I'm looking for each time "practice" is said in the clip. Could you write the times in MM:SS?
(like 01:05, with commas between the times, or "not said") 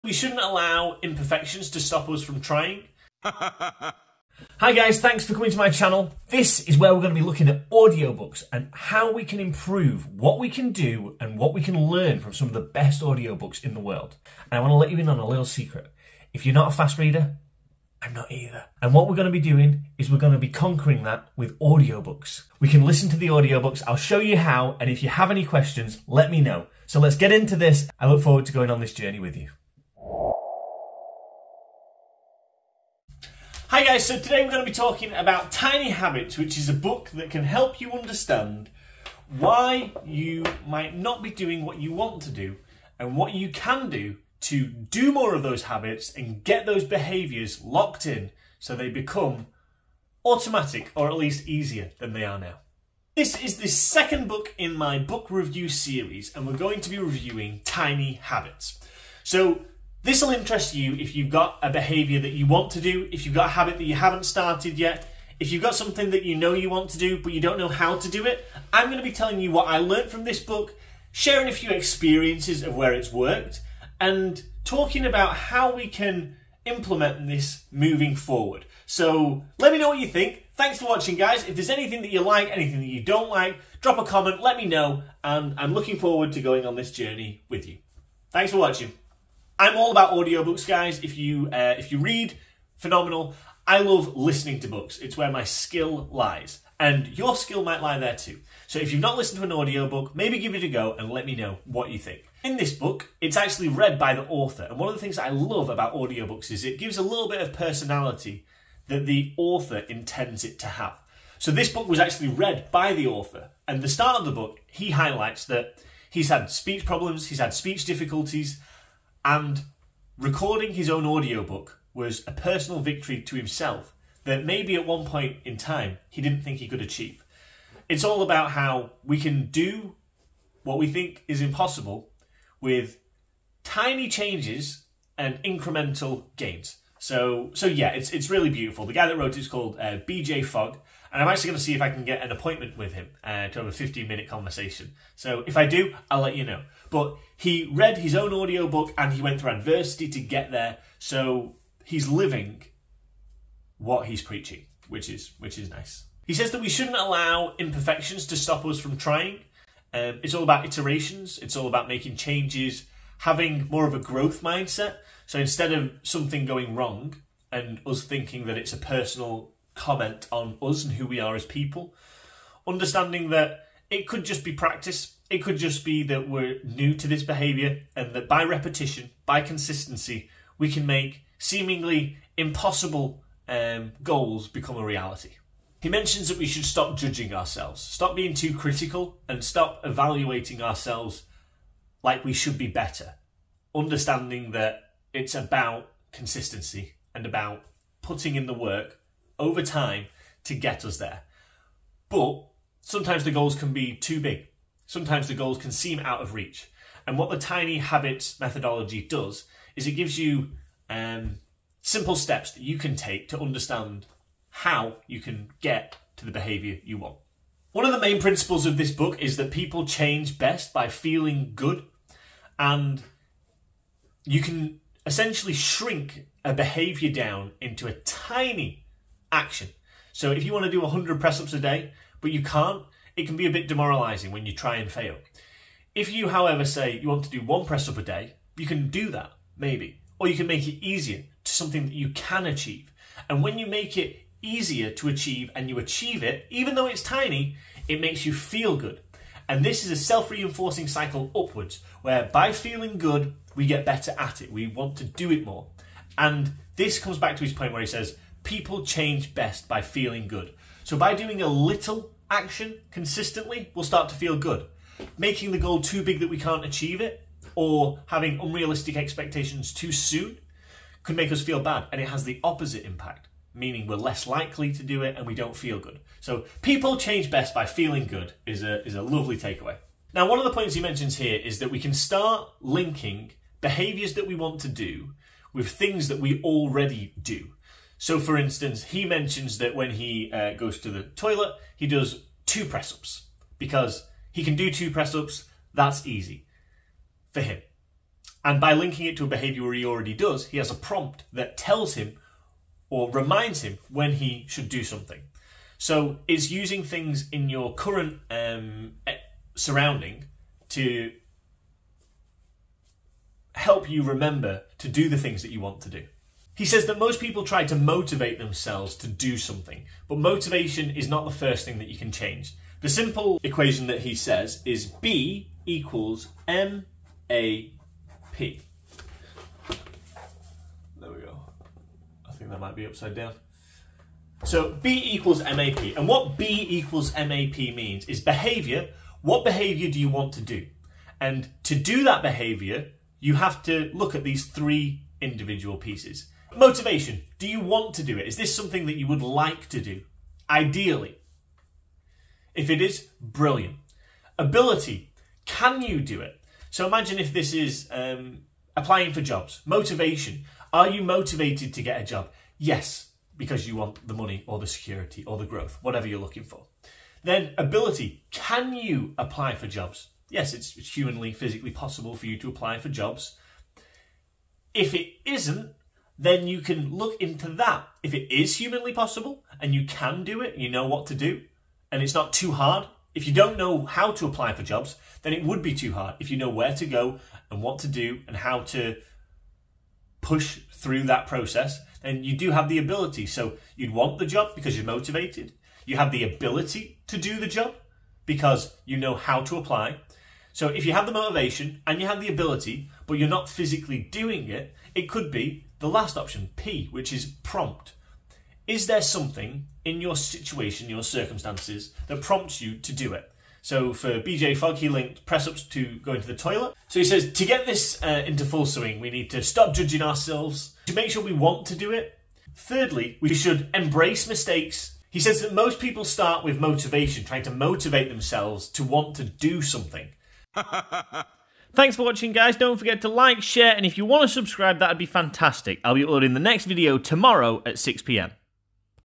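02:54.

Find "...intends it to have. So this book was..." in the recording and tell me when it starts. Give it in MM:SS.
01:49.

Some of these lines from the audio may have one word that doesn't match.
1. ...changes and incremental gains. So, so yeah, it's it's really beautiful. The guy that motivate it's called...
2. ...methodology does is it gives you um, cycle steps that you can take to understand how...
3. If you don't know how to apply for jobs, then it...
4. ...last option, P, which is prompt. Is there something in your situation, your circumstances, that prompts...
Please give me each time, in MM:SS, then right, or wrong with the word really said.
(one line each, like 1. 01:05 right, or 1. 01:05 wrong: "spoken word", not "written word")
1. 02:14 wrong: "wrote", not "motivate"
2. 03:28 wrong: "simple", not "cycle"
3. 06:23 right
4. 06:45 right.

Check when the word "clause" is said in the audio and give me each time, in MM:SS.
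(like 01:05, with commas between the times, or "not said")
not said.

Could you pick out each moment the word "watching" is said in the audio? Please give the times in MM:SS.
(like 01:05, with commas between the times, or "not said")
01:20, 01:28, 07:12.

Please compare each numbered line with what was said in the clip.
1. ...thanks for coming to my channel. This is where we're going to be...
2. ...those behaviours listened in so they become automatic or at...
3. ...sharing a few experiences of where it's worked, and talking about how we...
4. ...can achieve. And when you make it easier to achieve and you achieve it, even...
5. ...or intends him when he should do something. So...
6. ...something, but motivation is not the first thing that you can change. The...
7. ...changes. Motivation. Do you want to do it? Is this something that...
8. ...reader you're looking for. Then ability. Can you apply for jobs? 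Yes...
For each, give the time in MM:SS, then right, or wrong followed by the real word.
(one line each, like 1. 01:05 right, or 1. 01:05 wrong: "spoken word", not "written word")
1. 00:04 right
2. 00:46 wrong: "locked", not "listened"
3. 01:11 right
4. 04:02 right
5. 05:02 wrong: "reminds", not "intends"
6. 05:19 right
7. 05:45 wrong: "pieces", not "changes"
8. 06:05 wrong: "whatever", not "reader".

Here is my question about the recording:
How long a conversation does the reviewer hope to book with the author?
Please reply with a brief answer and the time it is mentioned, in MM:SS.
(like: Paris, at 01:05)
15 minutes, at 02:23.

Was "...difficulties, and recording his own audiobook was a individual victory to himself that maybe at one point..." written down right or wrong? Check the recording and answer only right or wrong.
wrong.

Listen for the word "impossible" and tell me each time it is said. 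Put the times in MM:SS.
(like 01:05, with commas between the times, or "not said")
02:11, 03:02.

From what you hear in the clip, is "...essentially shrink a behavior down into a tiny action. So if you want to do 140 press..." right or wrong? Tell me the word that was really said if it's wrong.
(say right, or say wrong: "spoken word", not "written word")
wrong: "100", not "140".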